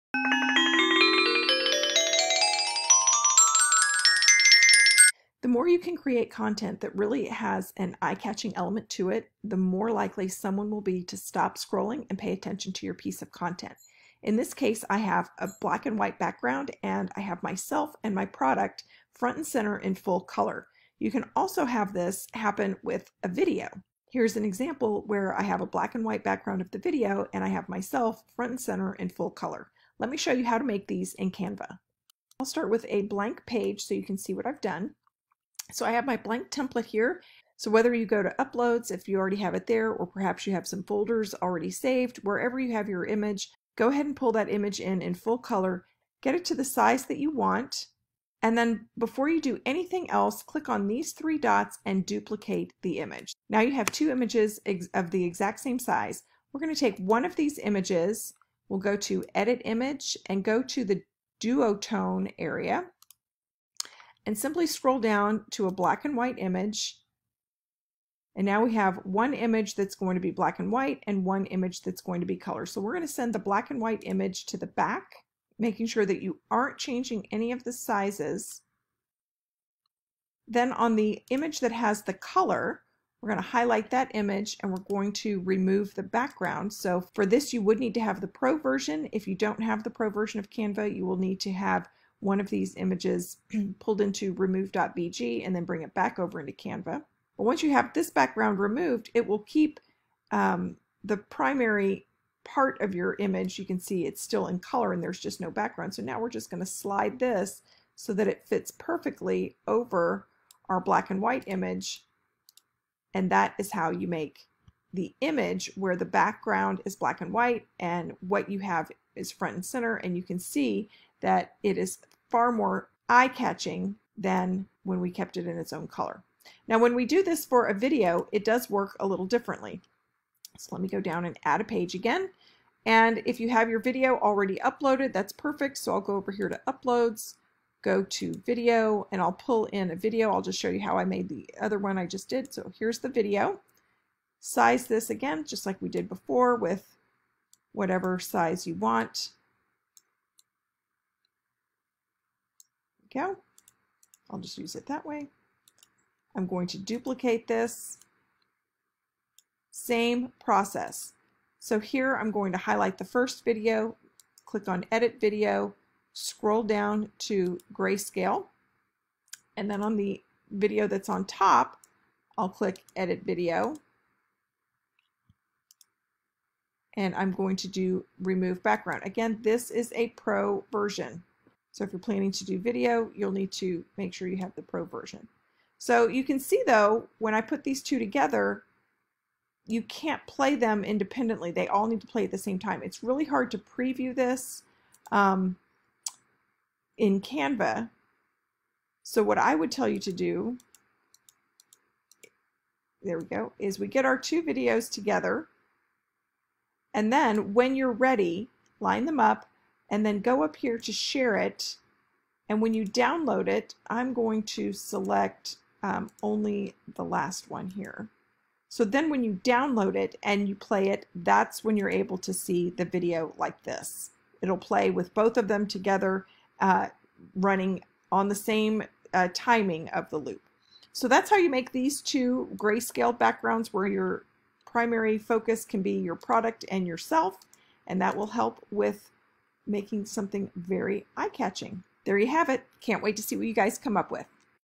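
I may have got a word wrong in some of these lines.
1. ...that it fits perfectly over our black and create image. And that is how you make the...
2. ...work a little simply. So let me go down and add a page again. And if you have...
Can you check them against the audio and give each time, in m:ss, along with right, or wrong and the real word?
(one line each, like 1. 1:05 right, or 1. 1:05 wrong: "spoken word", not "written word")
1. 1:48 wrong: "white", not "create"
2. 2:08 wrong: "differently", not "simply".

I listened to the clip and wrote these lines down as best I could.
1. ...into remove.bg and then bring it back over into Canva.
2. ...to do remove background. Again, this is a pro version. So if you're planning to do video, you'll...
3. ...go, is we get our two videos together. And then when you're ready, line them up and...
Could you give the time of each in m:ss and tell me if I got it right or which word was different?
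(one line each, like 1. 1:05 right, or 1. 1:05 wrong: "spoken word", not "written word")
1. 1:33 right
2. 2:57 right
3. 3:23 right.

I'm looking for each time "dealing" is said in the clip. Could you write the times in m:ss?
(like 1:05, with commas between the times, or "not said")
not said.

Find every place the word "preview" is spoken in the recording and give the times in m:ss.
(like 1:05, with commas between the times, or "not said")
3:13.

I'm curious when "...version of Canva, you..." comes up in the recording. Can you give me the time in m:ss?
1:30.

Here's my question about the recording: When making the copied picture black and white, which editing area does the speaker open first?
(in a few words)
duotone.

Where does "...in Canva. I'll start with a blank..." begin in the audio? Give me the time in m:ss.
0:31.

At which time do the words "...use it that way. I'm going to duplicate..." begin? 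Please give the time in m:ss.
2:34.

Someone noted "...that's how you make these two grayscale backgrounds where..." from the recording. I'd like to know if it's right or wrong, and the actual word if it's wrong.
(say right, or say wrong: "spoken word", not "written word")
right.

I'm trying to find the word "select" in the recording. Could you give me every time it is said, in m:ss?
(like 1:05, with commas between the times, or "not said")
3:34.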